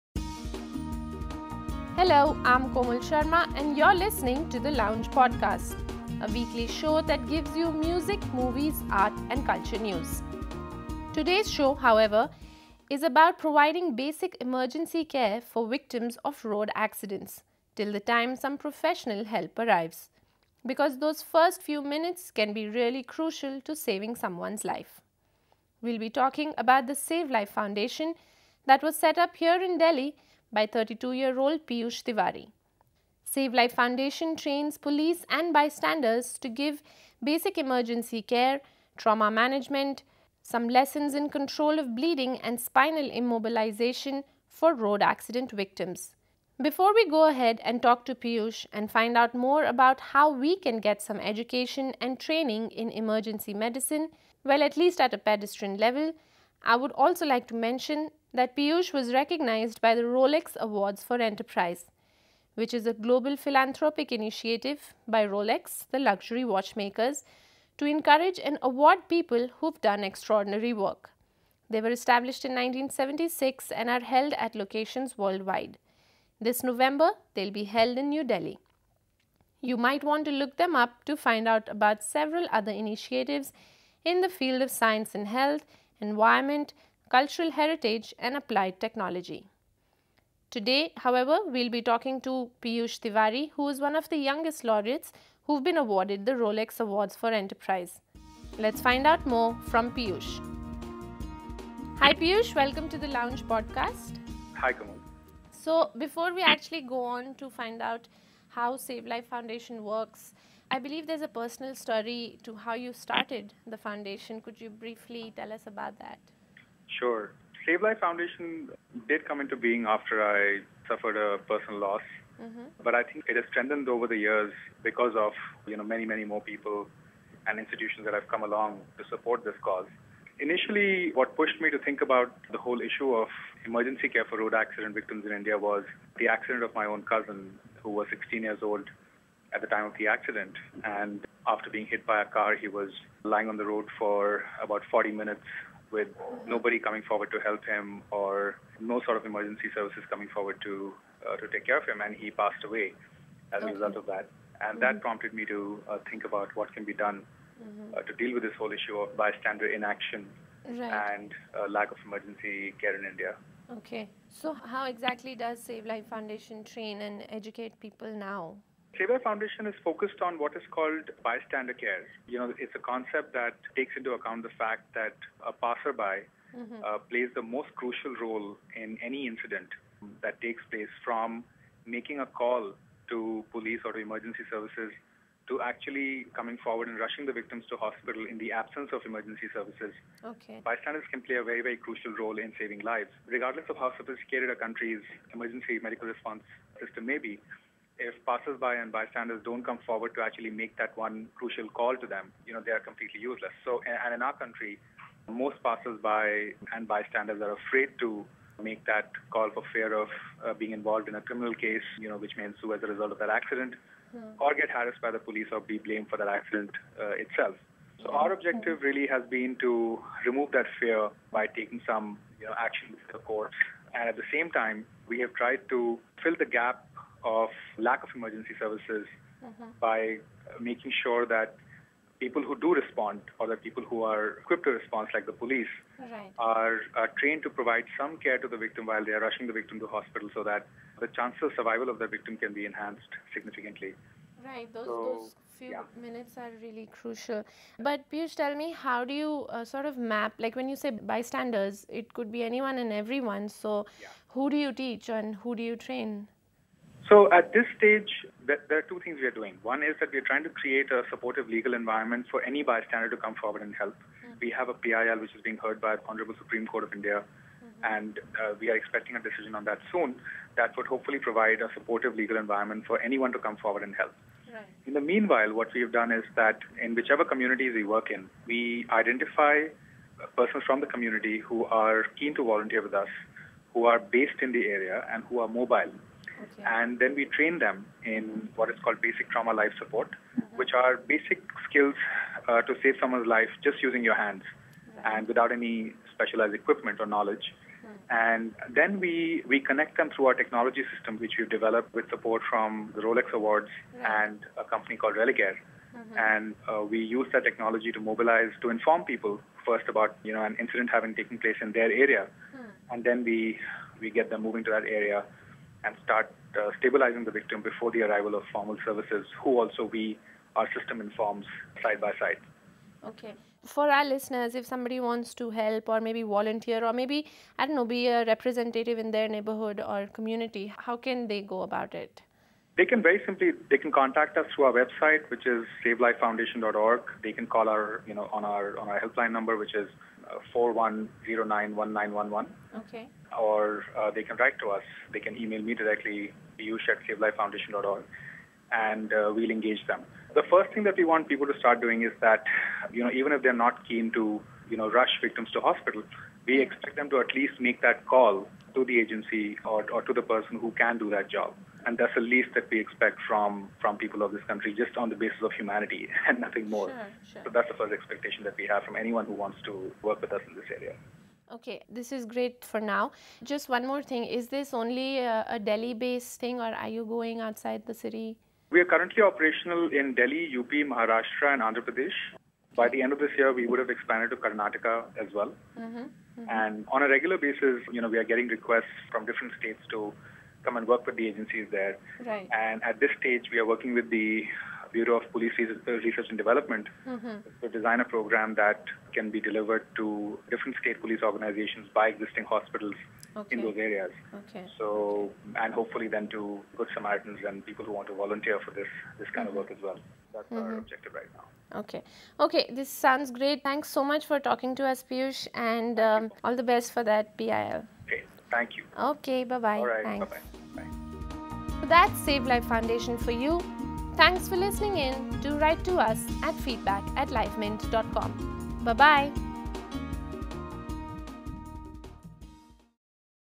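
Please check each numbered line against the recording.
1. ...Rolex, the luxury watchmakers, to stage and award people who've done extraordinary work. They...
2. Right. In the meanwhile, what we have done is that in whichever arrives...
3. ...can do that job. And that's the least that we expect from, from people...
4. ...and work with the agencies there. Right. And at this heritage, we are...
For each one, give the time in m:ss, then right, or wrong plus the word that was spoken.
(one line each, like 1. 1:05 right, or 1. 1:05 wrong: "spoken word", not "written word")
1. 1:05 wrong: "encourage", not "stage"
2. 4:34 wrong: "communities", not "arrives"
3. 6:00 right
4. 6:30 wrong: "stage", not "heritage".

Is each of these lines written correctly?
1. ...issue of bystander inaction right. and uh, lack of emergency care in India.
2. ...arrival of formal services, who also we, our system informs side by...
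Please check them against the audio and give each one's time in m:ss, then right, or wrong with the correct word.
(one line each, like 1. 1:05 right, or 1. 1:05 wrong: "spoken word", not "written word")
1. 2:38 right
2. 5:18 right.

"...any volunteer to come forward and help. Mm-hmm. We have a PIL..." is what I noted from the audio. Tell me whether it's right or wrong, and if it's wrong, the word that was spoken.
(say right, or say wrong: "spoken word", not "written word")
wrong: "bystander", not "volunteer".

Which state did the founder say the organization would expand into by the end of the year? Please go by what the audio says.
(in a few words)
Karnataka.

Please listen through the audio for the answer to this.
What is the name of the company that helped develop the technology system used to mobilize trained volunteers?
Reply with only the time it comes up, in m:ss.
5:05.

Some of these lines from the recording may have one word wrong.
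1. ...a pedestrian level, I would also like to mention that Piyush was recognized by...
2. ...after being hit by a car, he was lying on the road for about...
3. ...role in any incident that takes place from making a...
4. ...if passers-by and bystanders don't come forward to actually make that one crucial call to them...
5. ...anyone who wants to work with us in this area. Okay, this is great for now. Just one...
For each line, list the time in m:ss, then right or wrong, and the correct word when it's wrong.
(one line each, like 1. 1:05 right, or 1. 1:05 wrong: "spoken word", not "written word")
1. 0:55 right
2. 2:21 right
3. 2:58 right
4. 3:18 right
5. 6:08 right.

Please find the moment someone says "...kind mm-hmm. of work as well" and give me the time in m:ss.
6:49.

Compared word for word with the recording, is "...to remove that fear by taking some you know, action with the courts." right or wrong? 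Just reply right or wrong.
right.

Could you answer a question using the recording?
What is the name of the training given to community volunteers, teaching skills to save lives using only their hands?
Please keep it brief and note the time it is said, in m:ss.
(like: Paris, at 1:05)
basic trauma life support, at 4:49.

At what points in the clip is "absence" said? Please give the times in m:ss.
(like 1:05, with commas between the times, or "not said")
3:08.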